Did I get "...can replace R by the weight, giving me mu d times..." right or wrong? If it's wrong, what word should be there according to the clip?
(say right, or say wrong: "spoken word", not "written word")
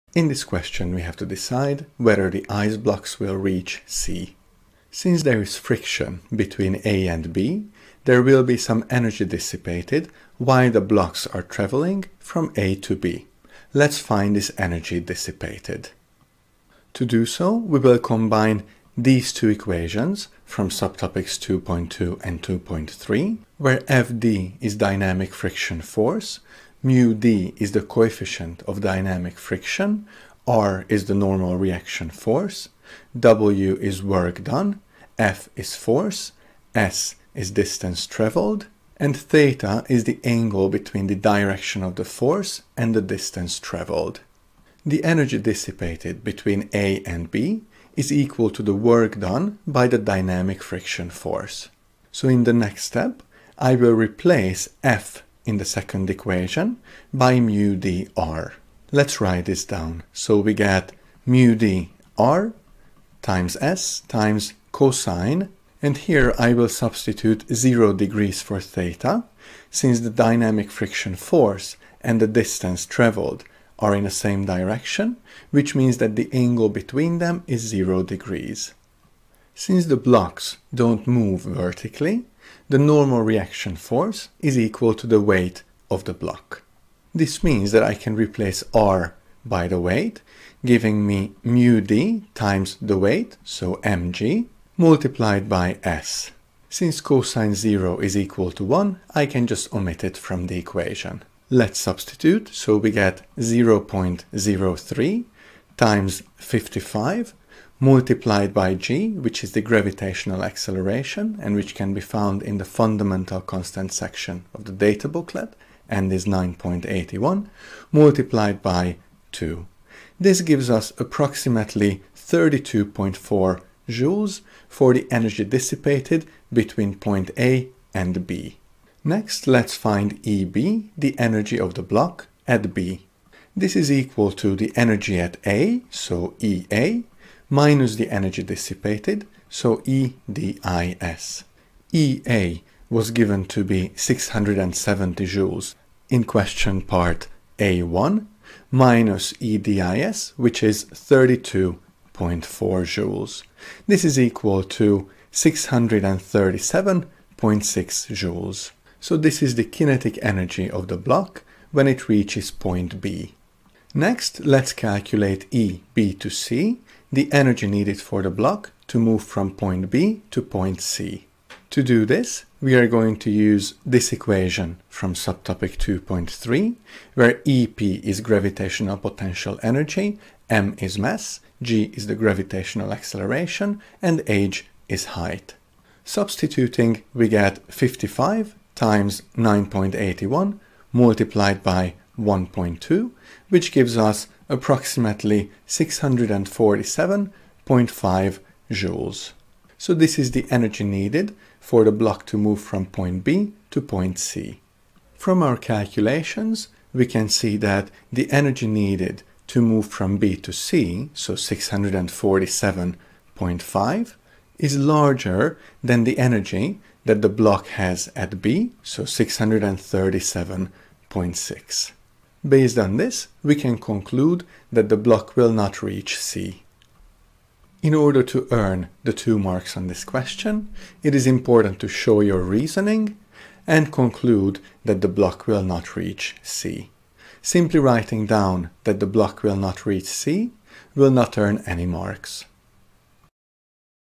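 right.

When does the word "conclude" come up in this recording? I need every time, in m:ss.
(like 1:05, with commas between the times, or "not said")
3:43, 3:53.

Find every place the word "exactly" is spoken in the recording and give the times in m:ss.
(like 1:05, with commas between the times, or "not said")
not said.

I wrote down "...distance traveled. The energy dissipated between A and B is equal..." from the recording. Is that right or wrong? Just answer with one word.
right.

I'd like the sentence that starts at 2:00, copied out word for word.
This gives us approximately 32.4 joules for the energy dissipated between point A and B.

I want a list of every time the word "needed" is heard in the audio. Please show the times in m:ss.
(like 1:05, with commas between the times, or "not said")
2:47, 3:20, 3:28.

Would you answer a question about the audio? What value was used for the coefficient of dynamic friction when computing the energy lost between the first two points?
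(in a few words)
0.03.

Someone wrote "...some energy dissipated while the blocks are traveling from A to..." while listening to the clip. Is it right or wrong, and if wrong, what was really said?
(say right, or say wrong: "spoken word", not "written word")
right.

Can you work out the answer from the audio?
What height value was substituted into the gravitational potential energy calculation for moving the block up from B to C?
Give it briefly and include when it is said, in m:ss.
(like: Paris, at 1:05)
1.2, at 3:12.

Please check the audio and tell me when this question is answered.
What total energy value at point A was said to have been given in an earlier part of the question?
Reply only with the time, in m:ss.
2:23.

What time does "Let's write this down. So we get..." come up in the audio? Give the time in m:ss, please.
0:58.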